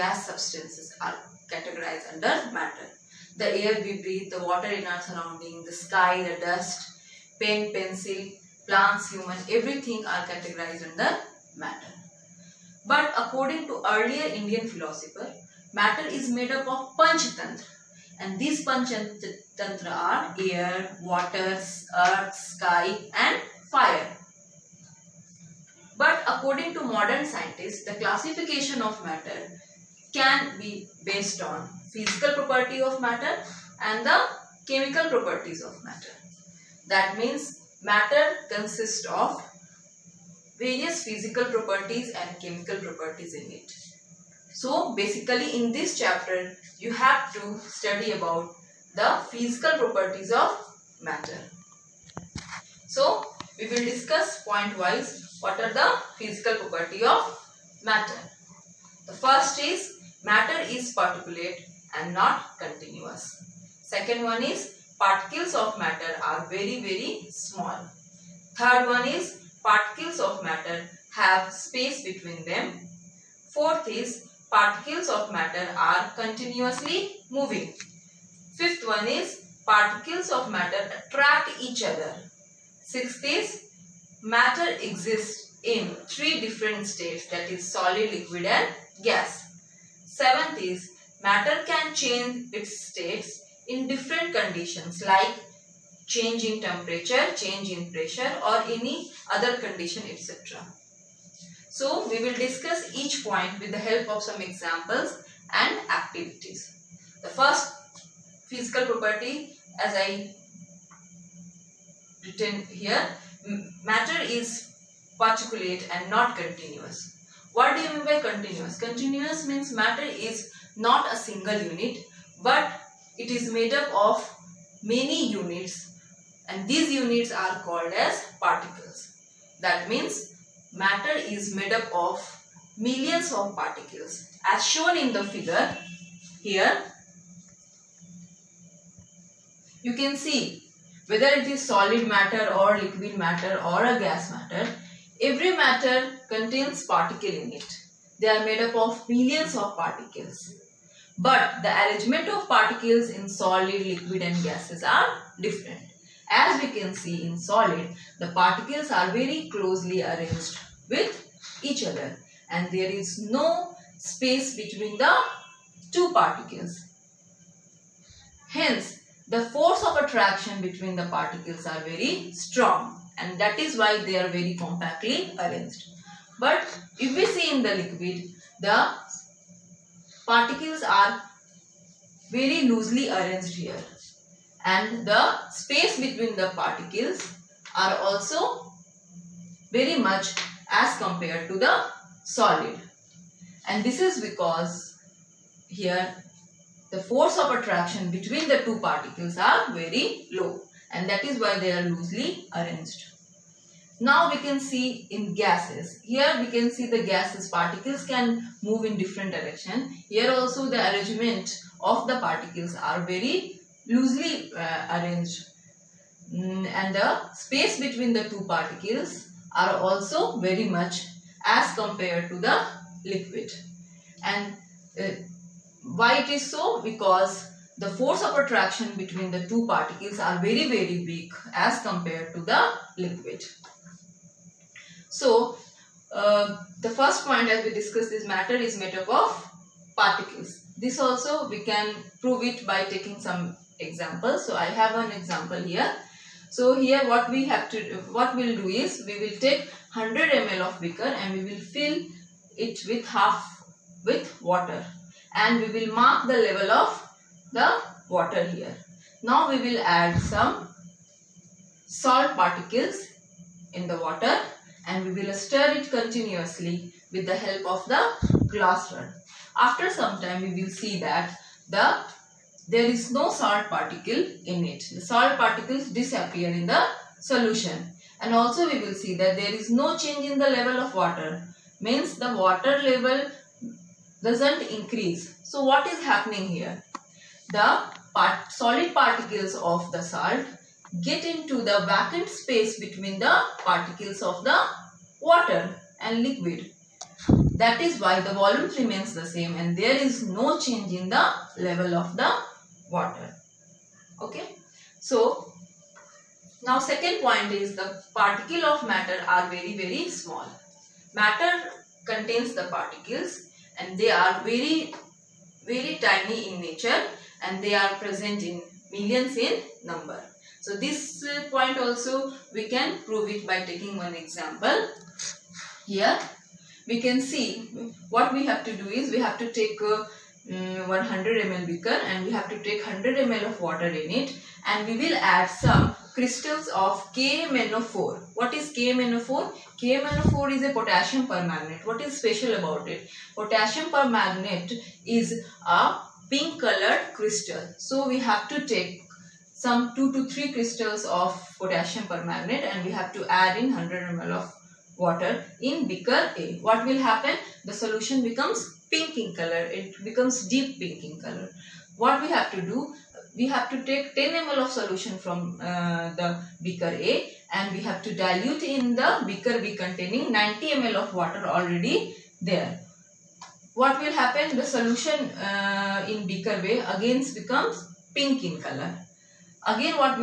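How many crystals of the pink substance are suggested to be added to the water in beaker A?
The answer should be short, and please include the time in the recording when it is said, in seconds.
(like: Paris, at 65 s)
2 to 3, at 349 s.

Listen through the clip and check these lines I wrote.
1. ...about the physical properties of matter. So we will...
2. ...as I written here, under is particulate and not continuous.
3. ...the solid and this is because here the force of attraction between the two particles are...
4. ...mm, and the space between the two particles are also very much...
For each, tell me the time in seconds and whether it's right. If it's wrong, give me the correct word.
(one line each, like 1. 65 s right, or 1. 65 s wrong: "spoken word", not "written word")
1. 48 s right
2. 109 s wrong: "matter", not "under"
3. 191 s right
4. 216 s right.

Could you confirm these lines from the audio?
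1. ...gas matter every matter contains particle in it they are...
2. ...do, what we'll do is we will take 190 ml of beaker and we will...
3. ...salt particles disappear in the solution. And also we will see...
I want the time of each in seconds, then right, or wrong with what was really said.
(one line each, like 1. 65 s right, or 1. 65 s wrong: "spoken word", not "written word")
1. 143 s right
2. 247 s wrong: "100", not "190"
3. 275 s right.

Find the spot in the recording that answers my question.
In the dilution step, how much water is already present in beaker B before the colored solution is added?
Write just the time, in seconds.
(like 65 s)
370 s.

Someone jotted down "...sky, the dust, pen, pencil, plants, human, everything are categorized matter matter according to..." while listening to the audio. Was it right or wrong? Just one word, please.
wrong.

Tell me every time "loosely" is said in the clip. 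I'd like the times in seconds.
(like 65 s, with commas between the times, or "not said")
182 s, 201 s, 213 s.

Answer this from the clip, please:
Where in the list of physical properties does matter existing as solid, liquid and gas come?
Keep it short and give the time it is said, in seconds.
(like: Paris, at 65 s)
Sixth, at 82 s.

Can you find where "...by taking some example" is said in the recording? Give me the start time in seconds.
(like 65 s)
242 s.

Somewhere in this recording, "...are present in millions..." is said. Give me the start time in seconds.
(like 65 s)
317 s.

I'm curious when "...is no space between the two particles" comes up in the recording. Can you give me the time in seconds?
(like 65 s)
162 s.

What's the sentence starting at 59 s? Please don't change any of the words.
The first is matter is particulate and not continuous.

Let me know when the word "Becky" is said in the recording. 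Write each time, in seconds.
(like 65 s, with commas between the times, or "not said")
not said.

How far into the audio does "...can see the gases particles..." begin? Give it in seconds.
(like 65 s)
206 s.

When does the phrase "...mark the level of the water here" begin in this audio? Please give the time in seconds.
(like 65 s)
255 s.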